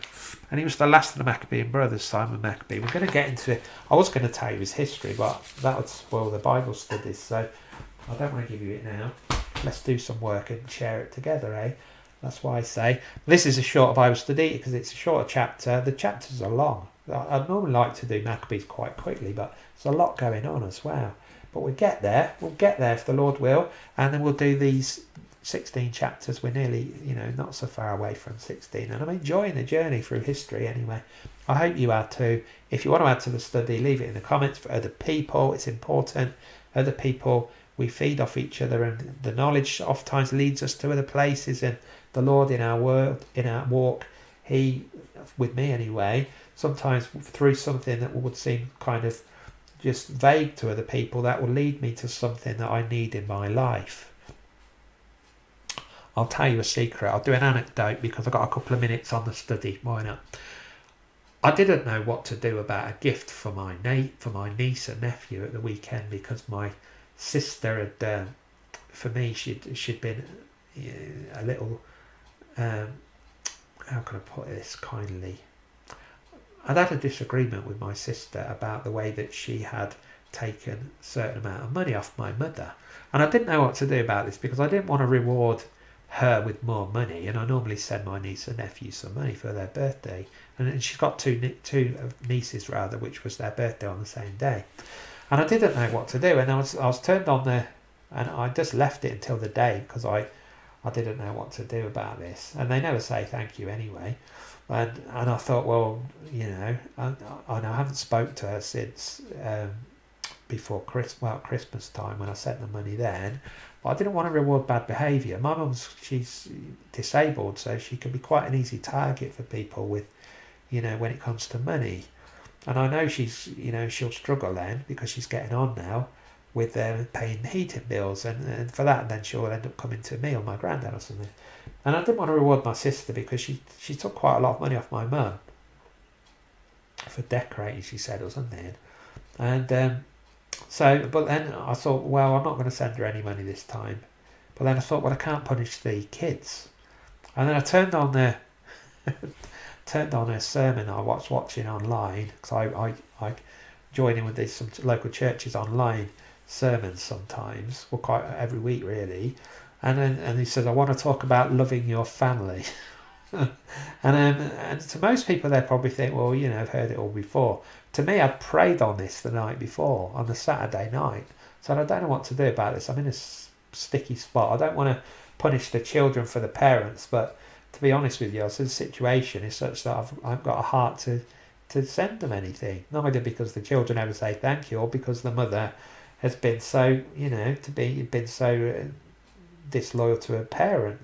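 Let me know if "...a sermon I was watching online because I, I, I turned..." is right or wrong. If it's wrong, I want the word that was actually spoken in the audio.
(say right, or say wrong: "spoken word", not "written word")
wrong: "joined", not "turned".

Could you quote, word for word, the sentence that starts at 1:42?
And they never say thank you anyway.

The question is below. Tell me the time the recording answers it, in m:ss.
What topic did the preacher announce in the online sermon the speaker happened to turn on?
2:41.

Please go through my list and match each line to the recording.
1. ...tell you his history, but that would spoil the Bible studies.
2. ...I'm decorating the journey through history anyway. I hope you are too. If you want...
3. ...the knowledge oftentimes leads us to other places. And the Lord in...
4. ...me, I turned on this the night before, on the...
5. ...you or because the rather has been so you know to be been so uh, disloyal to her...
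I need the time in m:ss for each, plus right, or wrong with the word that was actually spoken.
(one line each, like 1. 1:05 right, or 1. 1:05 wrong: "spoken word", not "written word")
1. 0:04 right
2. 0:29 wrong: "enjoying", not "decorating"
3. 0:39 right
4. 2:48 wrong: "prayed", not "turned"
5. 3:04 wrong: "mother", not "rather".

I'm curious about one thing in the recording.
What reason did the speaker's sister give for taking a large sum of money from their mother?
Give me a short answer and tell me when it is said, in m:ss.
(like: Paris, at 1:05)
Decorating, at 2:17.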